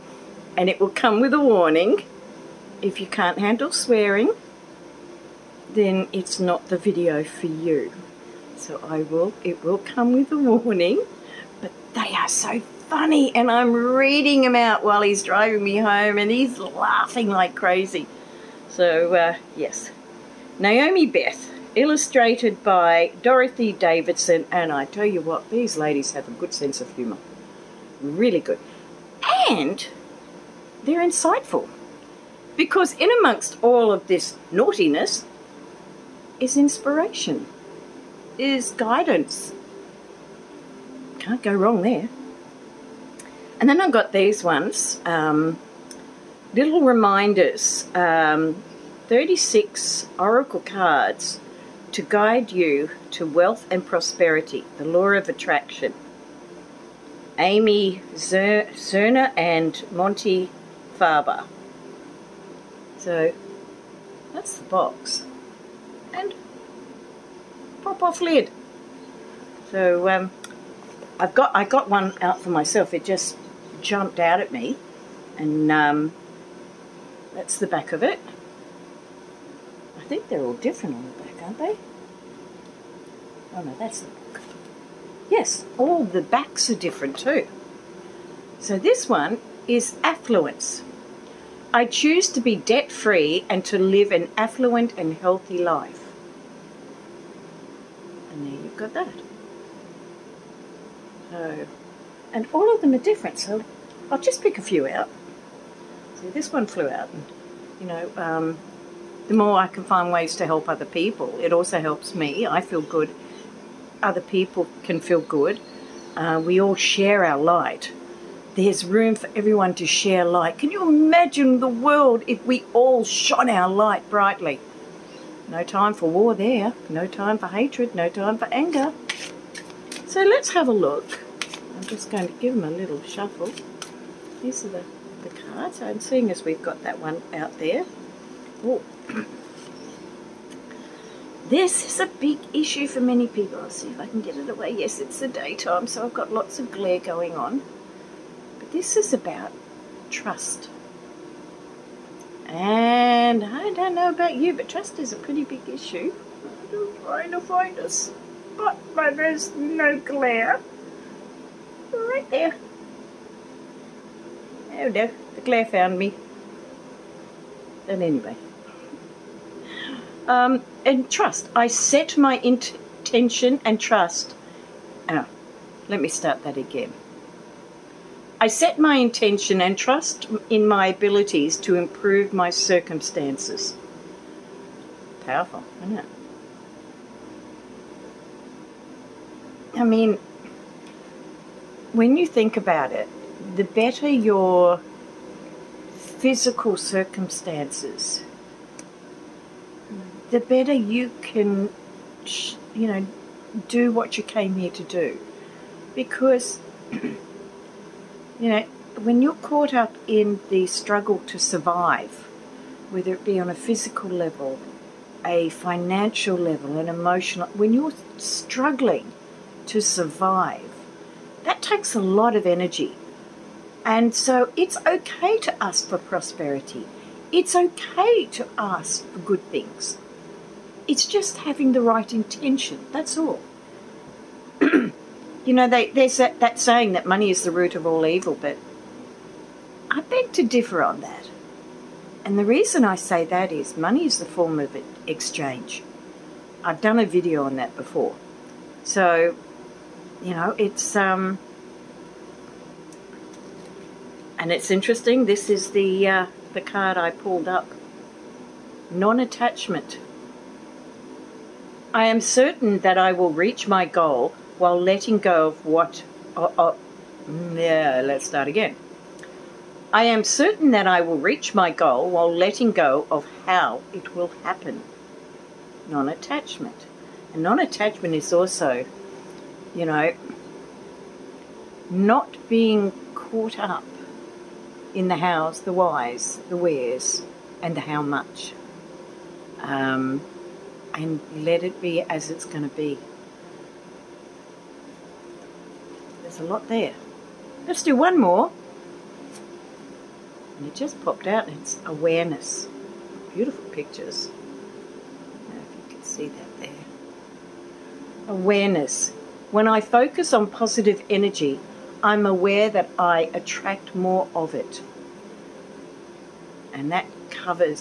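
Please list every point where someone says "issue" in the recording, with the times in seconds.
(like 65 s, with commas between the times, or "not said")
142 s, 155 s.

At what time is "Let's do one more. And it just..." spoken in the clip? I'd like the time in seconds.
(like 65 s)
297 s.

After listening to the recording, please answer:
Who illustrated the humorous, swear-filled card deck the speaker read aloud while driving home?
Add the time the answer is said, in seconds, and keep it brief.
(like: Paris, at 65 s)
Dorothy Davidson, at 23 s.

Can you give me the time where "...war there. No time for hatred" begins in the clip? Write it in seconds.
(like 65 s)
126 s.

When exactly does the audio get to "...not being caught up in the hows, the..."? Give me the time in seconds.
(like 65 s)
281 s.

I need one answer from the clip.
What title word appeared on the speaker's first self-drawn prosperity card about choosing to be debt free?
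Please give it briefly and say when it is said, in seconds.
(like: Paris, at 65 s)
Affluence, at 90 s.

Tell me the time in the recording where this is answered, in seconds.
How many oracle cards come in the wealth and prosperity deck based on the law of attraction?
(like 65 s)
49 s.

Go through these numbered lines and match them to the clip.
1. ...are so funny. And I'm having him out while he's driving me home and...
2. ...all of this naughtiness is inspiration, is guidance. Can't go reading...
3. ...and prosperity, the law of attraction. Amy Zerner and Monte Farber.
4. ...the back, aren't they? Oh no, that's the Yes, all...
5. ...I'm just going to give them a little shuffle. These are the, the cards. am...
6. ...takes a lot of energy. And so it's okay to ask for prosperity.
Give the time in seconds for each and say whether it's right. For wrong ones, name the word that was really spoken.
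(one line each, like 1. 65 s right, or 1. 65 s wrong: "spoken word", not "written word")
1. 12 s wrong: "reading", not "having"
2. 33 s wrong: "wrong", not "reading"
3. 53 s right
4. 81 s right
5. 131 s right
6. 221 s right.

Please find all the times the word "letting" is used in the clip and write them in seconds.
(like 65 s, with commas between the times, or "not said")
264 s, 272 s.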